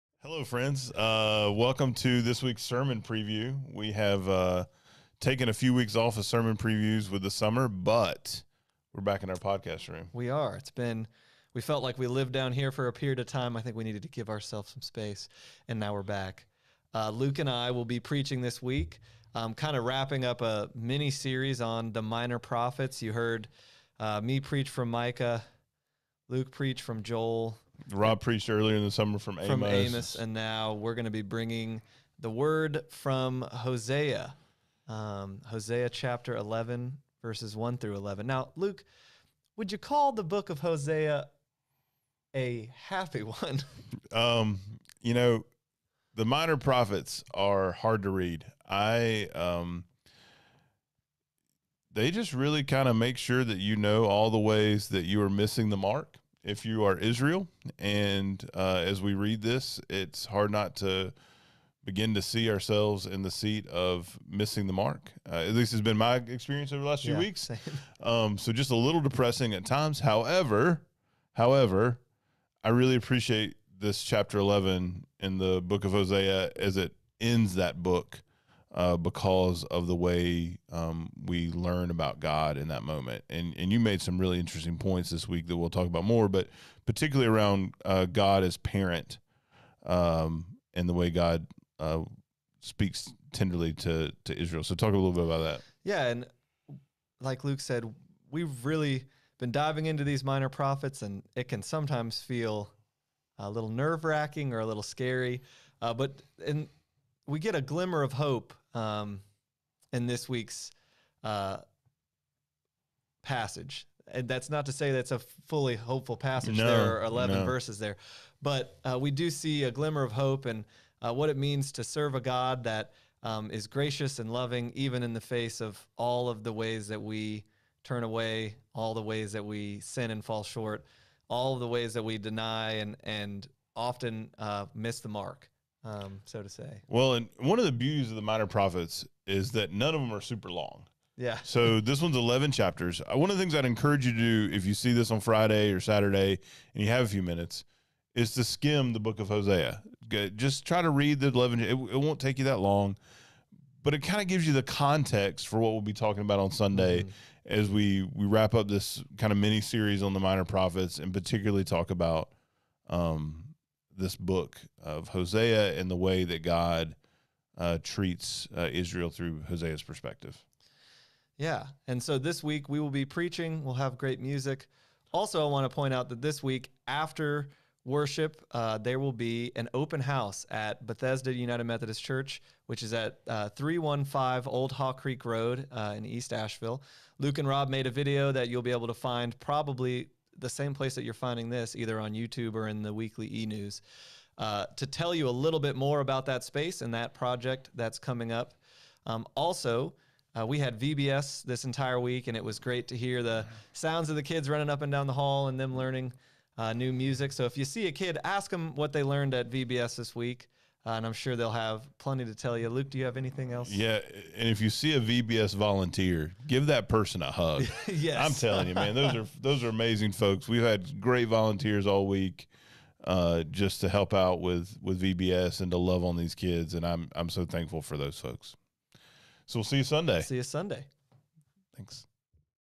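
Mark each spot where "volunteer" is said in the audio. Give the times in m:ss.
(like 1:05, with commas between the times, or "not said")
3:35, 3:41.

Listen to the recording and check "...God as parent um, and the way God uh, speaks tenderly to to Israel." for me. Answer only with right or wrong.
right.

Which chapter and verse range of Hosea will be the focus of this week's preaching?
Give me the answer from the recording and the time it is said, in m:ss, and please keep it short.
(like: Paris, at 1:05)
Chapter 11, verses 1-11, at 0:35.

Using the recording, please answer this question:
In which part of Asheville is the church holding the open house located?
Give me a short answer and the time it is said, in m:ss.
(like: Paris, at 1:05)
East Asheville, at 3:06.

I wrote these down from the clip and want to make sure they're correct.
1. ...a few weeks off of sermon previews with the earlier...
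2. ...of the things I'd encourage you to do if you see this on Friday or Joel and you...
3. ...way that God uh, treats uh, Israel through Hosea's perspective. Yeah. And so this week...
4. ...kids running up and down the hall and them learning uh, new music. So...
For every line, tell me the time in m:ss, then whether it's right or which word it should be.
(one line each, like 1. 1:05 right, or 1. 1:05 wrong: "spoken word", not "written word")
1. 0:05 wrong: "summer", not "earlier"
2. 2:23 wrong: "Saturday", not "Joel"
3. 2:45 right
4. 3:24 right.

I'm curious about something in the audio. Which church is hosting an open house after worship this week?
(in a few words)
Bethesda United Methodist Church.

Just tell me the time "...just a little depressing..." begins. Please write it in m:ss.
1:08.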